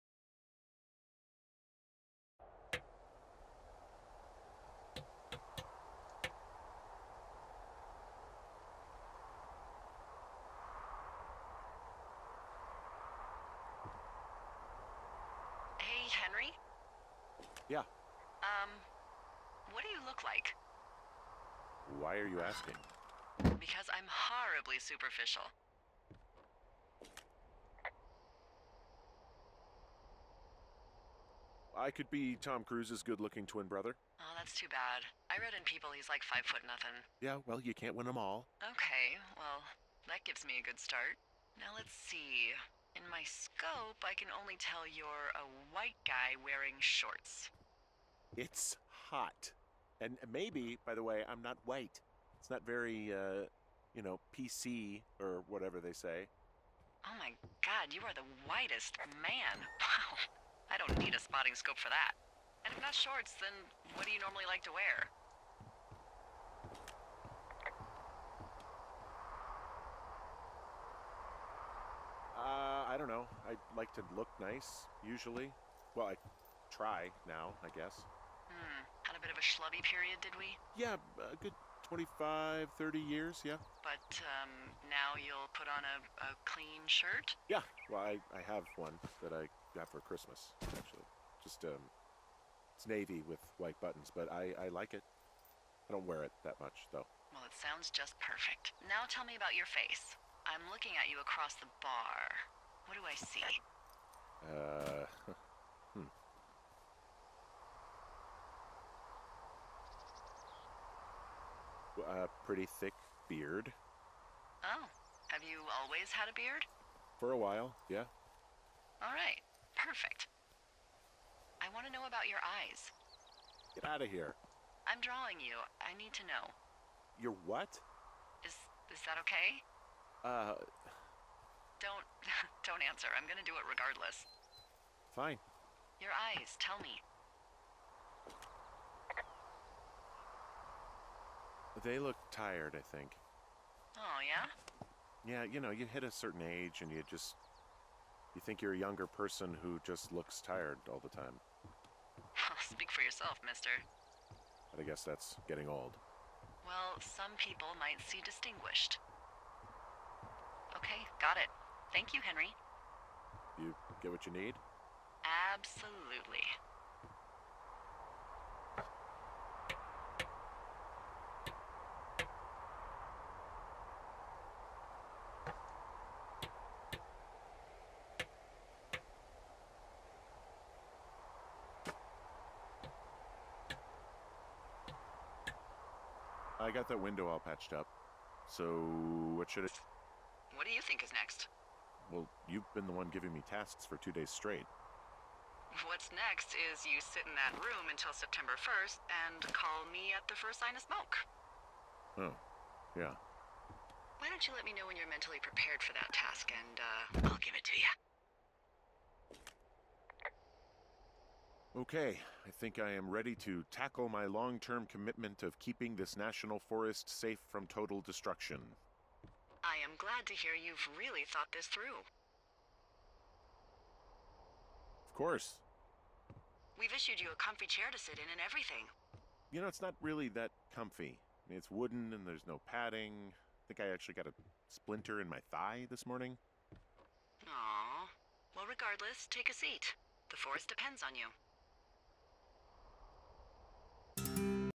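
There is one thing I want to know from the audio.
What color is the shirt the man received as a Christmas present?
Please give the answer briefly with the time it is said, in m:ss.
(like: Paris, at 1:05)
navy, at 1:32.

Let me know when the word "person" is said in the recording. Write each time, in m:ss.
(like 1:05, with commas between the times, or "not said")
2:29.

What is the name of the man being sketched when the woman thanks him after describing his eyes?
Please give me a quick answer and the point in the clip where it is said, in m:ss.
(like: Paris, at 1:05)
Henry, at 2:42.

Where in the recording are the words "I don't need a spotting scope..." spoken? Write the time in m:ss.
1:00.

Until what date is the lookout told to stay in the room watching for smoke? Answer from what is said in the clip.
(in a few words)
September 1.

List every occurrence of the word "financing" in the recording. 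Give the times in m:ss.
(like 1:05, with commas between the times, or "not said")
not said.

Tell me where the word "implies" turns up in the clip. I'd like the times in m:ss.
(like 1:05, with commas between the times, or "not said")
not said.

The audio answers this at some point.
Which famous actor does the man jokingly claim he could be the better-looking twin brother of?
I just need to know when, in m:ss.
0:32.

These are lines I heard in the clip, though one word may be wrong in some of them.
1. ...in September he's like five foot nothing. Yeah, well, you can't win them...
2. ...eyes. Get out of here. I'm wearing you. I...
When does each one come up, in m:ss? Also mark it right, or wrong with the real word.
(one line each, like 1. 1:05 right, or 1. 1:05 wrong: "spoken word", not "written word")
1. 0:35 wrong: "People", not "September"
2. 2:02 wrong: "drawing", not "wearing".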